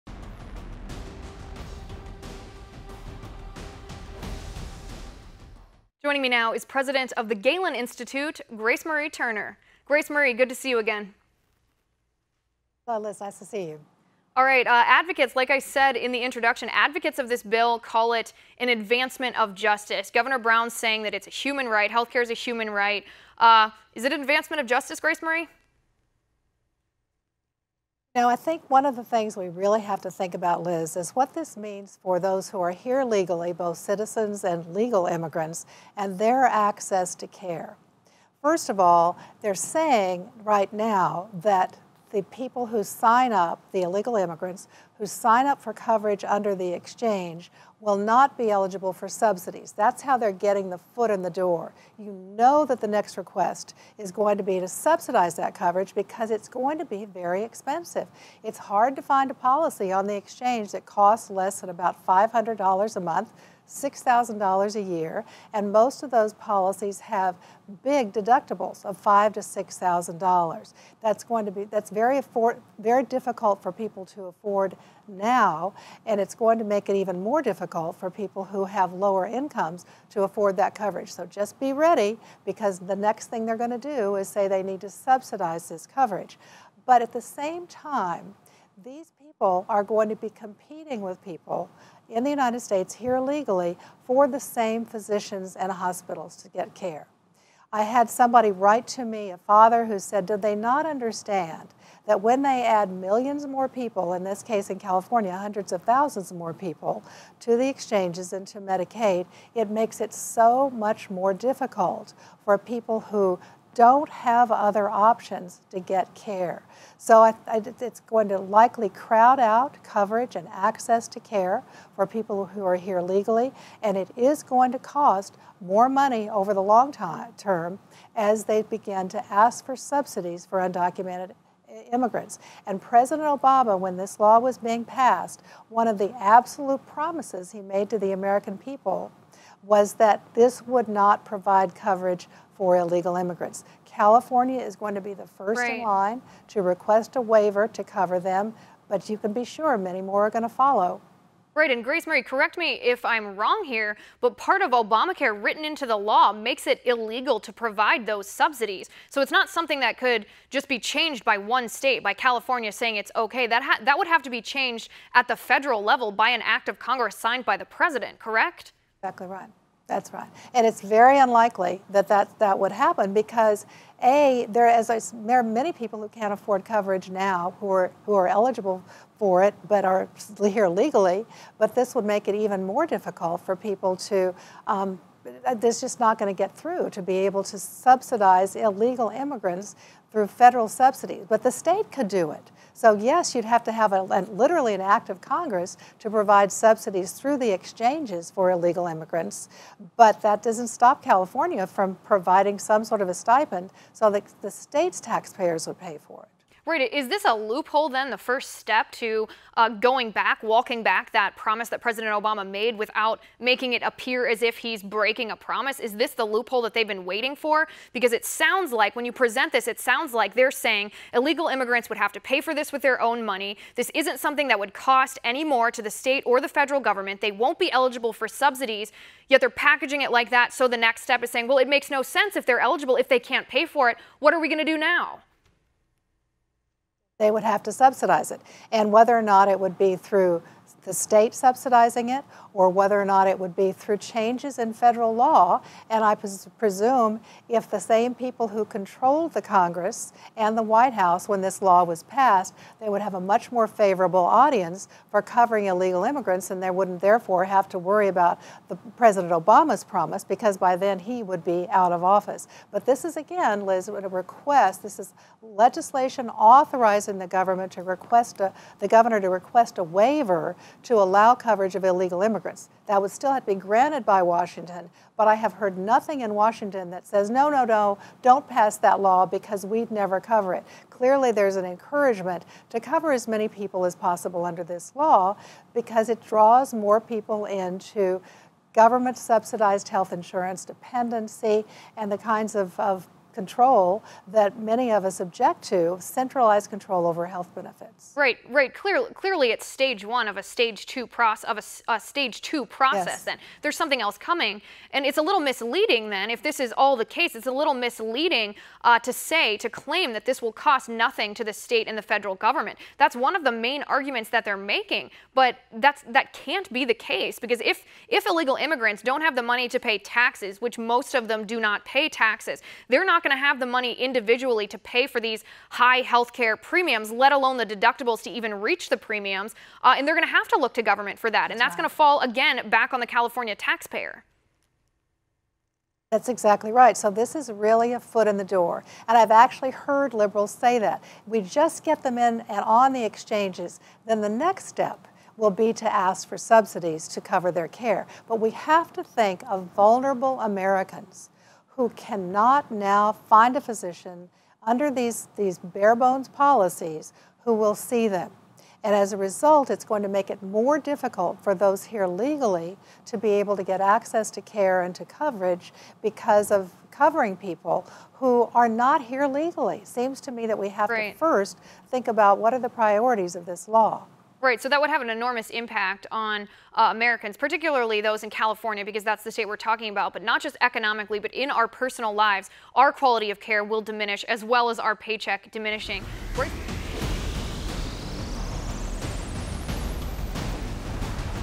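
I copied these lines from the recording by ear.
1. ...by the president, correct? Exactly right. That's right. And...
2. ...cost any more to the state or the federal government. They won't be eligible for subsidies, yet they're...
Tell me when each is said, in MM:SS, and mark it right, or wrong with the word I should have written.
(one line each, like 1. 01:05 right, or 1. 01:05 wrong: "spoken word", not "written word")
1. 02:47 right
2. 03:44 right.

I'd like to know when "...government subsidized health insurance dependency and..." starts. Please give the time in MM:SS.
04:48.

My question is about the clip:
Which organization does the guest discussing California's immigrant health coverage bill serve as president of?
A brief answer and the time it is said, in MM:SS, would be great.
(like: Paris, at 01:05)
Galen Institute, at 00:07.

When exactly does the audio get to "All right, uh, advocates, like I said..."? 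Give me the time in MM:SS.
00:14.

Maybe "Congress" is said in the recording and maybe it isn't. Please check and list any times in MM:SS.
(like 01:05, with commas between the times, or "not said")
02:46, 03:15, 04:09.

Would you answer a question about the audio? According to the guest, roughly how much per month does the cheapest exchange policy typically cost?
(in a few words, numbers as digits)
$500.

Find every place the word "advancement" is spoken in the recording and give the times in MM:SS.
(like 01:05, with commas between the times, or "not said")
00:18, 00:24.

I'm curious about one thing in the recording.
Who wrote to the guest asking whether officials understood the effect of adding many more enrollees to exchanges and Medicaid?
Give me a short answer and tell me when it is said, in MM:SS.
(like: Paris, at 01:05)
a father, at 01:39.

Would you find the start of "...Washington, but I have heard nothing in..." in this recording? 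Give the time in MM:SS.
04:34.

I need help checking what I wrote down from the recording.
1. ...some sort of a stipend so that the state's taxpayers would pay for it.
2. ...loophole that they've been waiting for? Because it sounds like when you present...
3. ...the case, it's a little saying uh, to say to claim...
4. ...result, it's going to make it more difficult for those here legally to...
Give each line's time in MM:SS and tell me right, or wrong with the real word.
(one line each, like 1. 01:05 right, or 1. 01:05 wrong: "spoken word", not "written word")
1. 03:22 right
2. 03:36 right
3. 05:06 wrong: "misleading", not "saying"
4. 05:59 right.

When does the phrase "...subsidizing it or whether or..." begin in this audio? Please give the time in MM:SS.
04:01.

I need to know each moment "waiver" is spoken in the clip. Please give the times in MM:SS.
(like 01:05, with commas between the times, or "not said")
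02:27, 04:29.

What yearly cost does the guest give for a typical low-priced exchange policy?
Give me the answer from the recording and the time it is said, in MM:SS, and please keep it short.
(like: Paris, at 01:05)
$6,000, at 01:03.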